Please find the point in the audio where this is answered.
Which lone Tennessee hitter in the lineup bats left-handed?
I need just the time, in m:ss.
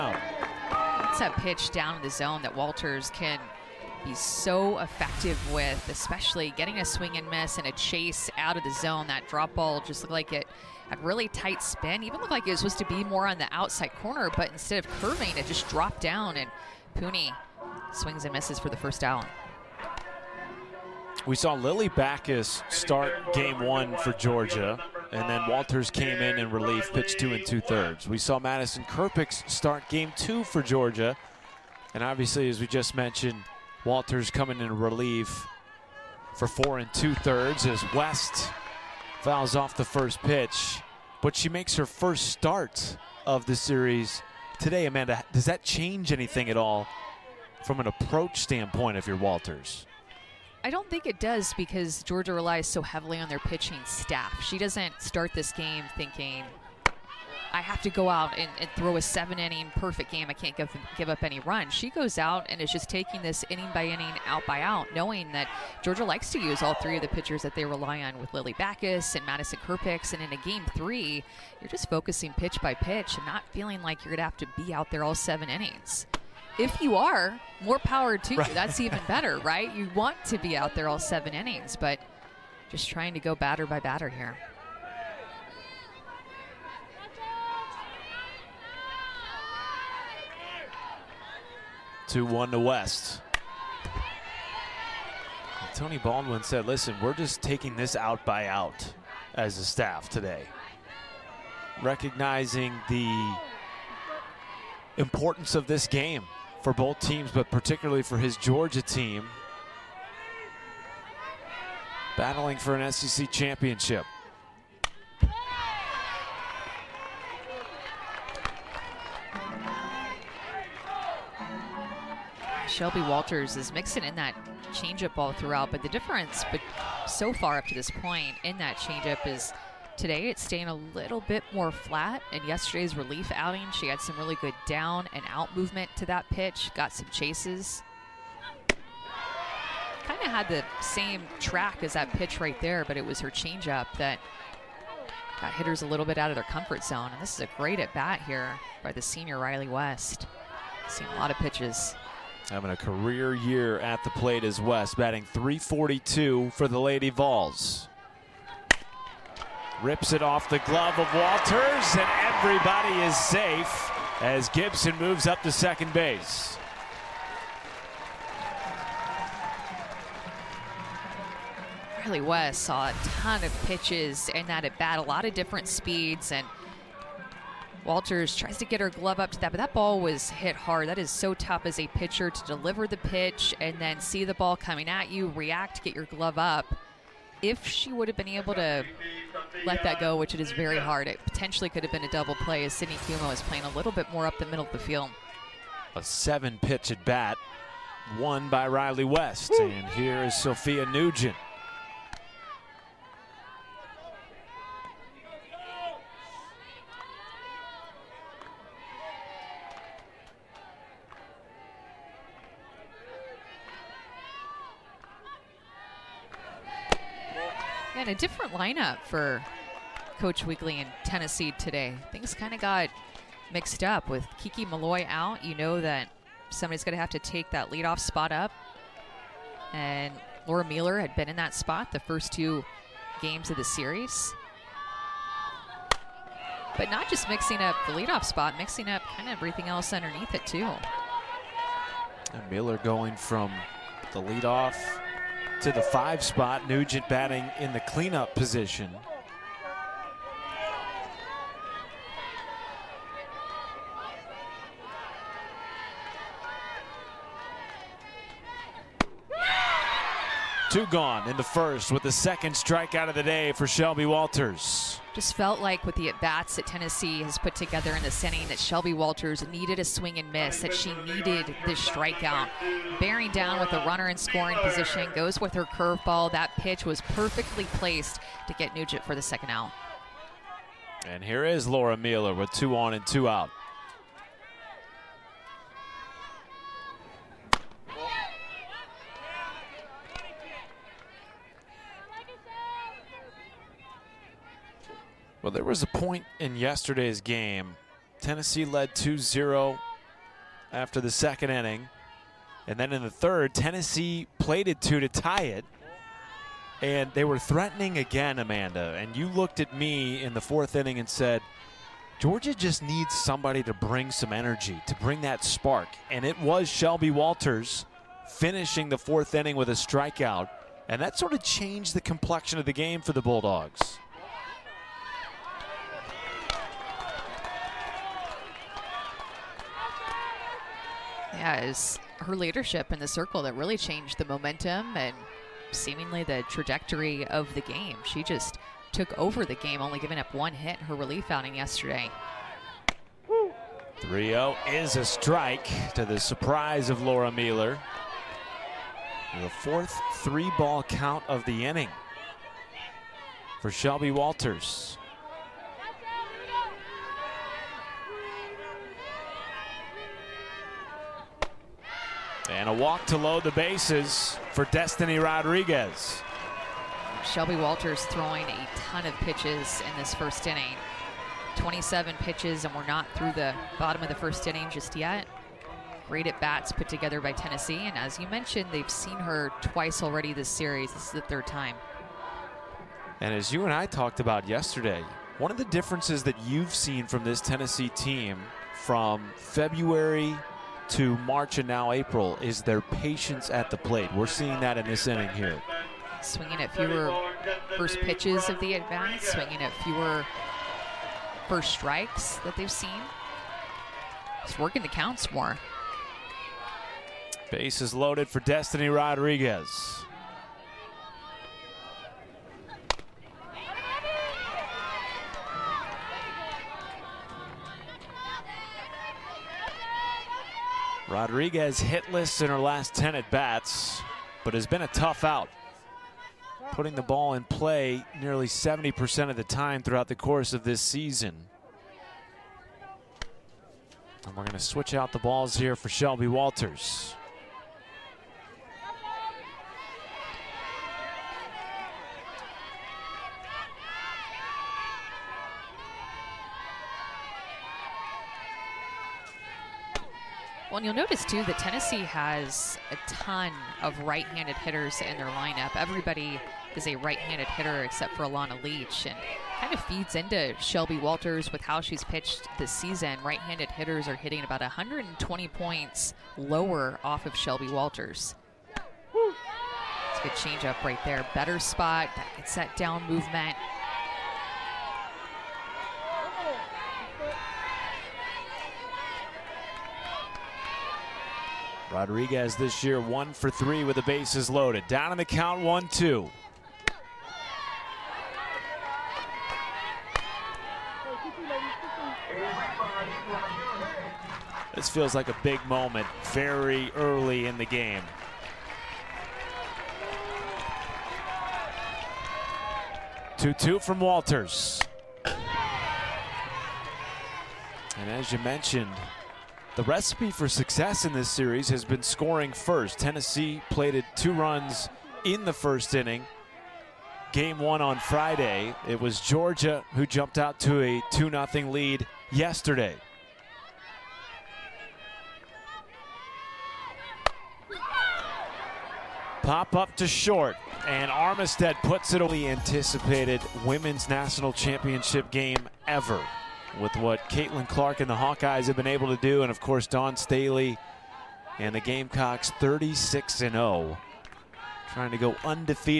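7:38.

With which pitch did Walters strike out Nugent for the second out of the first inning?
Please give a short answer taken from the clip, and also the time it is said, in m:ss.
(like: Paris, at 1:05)
curveball, at 4:35.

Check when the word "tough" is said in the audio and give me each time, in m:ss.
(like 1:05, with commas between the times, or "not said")
3:01, 7:04.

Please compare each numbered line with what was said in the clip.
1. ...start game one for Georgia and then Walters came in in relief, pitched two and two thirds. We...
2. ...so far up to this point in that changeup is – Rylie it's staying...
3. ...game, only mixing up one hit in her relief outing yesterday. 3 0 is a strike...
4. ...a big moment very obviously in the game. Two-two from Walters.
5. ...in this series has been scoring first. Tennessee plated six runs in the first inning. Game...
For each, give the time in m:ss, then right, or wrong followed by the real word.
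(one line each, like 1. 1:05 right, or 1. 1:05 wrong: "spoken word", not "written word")
1. 0:22 right
2. 2:07 wrong: "Today", not "Rylie"
3. 5:39 wrong: "giving", not "mixing"
4. 8:15 wrong: "early", not "obviously"
5. 8:31 wrong: "two", not "six".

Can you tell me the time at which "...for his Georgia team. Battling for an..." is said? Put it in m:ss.
1:48.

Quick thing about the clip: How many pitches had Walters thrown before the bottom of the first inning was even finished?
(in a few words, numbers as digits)
27.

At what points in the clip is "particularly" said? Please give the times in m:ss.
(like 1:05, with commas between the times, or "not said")
1:47.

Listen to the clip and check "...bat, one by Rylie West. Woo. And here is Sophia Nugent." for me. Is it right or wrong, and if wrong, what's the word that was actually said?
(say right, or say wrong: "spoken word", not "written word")
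right.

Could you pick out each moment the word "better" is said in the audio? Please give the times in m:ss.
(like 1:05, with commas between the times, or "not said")
1:19, 7:51.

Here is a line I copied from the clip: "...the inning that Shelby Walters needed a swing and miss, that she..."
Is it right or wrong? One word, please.
right.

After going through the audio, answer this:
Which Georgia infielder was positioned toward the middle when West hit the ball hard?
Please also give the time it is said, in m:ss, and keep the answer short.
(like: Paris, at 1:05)
Sydney Kuma, at 3:12.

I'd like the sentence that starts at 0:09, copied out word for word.
That drop ball just looked like it had really tight spin.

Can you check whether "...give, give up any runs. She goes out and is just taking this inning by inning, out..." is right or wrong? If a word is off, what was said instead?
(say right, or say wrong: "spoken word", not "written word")
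right.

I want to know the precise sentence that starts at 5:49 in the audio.
The fourth three ball count of the inning for Shelby Walters.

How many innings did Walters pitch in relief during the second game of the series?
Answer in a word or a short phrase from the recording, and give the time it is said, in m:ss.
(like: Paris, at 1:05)
four and two thirds, at 0:36.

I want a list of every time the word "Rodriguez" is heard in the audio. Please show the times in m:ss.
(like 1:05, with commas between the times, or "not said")
6:05, 6:48, 7:01, 8:01.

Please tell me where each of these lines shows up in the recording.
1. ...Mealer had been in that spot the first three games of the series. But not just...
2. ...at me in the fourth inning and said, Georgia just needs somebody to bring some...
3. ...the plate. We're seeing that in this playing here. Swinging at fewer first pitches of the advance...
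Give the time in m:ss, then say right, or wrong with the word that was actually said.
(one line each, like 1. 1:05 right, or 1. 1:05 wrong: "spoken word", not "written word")
1. 3:50 wrong: "two", not "three"
2. 5:09 right
3. 6:33 wrong: "inning", not "playing".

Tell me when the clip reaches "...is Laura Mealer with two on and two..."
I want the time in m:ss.
4:41.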